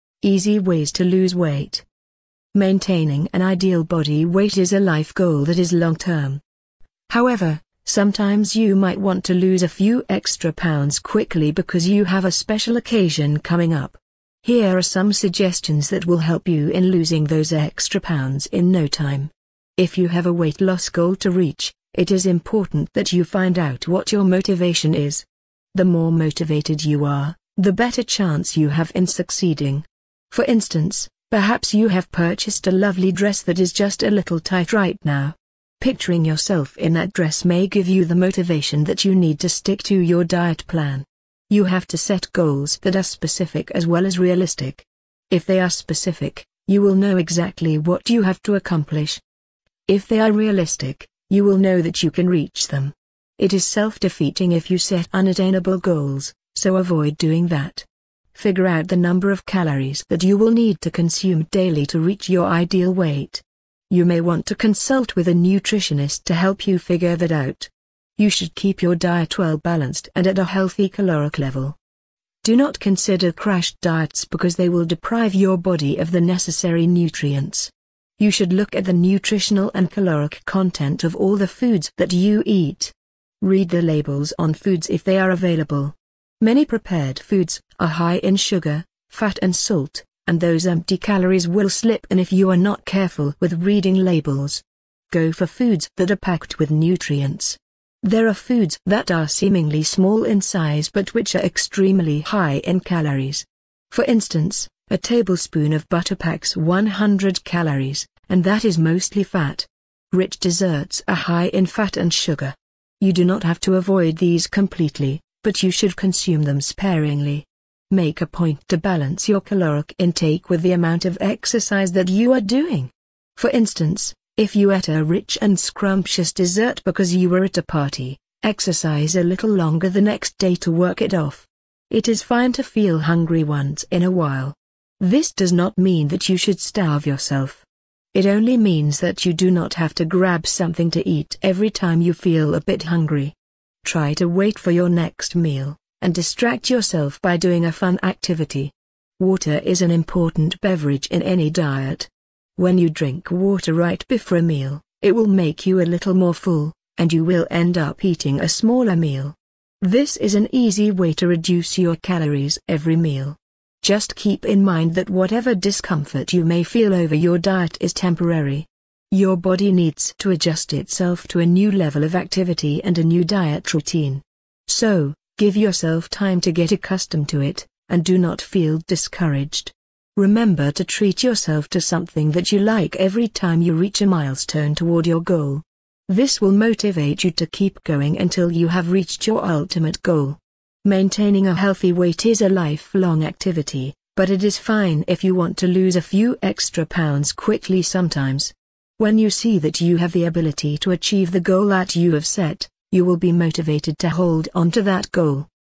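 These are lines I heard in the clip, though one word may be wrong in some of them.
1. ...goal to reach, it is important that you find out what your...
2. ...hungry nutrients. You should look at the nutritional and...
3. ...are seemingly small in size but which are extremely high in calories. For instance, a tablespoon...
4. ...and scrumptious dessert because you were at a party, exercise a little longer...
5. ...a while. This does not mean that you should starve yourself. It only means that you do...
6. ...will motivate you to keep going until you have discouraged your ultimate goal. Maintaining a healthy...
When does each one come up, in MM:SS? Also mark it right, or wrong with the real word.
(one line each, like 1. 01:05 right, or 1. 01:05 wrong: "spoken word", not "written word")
1. 00:20 right
2. 01:16 wrong: "necessary", not "hungry"
3. 01:39 right
4. 02:05 right
5. 02:14 right
6. 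03:06 wrong: "reached", not "discouraged".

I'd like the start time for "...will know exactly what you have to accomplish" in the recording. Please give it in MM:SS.
00:46.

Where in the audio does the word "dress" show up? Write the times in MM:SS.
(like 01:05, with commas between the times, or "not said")
00:33, 00:37.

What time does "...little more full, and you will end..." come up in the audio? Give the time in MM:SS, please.
02:35.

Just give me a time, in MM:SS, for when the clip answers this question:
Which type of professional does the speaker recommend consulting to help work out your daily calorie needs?
01:05.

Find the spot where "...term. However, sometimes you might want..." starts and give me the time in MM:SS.
00:05.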